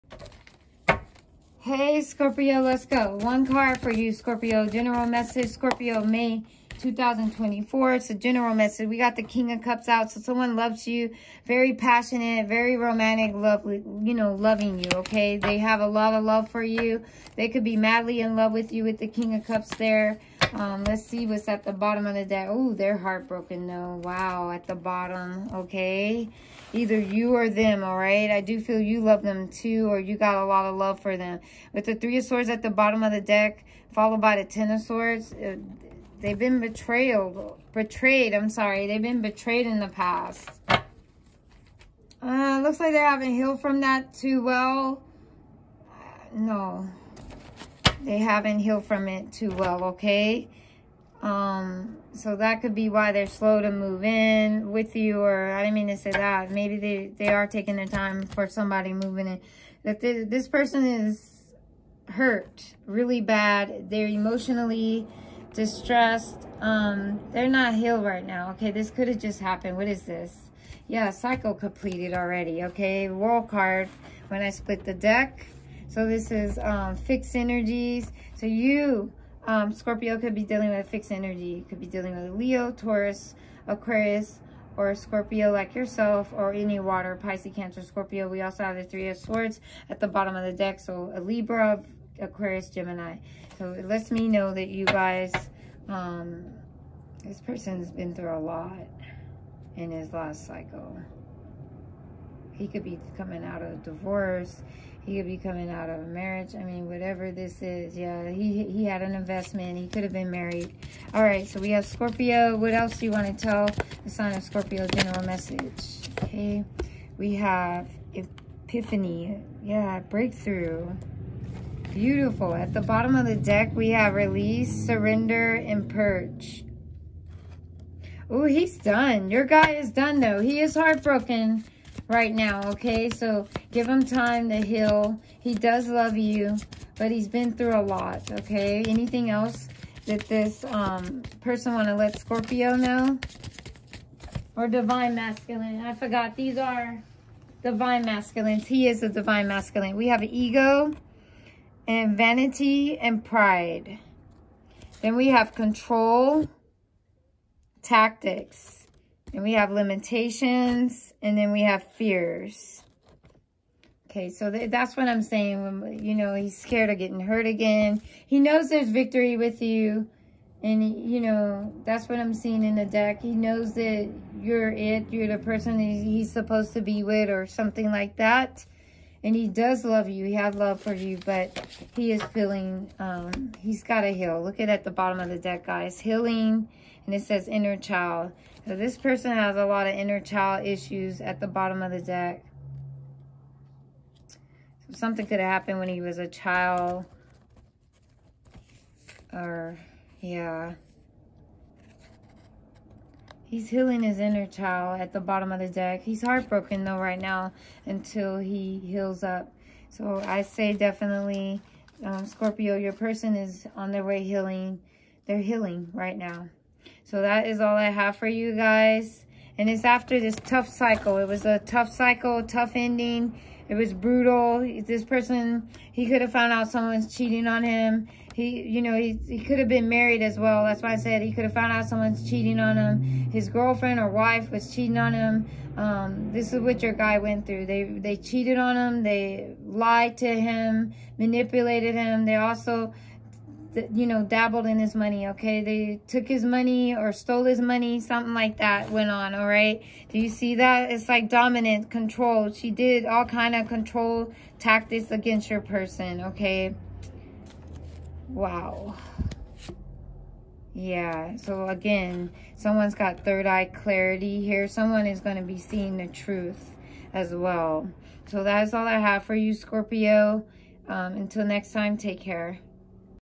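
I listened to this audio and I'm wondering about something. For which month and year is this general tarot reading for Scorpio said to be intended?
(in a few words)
May 2024.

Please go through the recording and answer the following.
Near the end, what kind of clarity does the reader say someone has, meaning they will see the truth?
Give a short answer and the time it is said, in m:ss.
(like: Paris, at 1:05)
Third eye clarity, at 4:23.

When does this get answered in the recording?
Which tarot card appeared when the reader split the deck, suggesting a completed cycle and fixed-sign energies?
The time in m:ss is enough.
1:13.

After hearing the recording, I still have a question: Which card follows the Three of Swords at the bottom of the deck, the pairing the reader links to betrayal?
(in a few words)
Ten of Swords.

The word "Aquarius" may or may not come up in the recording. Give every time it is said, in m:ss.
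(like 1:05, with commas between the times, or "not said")
1:23, 1:32.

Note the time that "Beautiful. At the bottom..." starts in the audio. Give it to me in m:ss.
2:01.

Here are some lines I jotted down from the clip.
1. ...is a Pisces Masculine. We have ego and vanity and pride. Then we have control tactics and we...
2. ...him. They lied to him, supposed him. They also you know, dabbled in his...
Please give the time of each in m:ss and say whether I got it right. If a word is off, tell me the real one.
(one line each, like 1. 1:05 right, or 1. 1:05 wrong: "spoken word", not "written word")
1. 2:28 wrong: "Divine", not "Pisces"
2. 3:58 wrong: "manipulated", not "supposed".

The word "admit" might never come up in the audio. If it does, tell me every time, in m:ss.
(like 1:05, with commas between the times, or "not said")
not said.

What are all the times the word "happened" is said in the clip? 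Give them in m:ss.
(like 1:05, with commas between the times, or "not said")
1:09, 3:15.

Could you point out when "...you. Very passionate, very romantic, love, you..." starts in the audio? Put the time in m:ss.
0:10.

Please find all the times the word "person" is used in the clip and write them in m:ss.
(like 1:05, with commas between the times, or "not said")
1:00, 1:37, 2:21, 2:55, 3:08, 3:32, 3:45, 4:15.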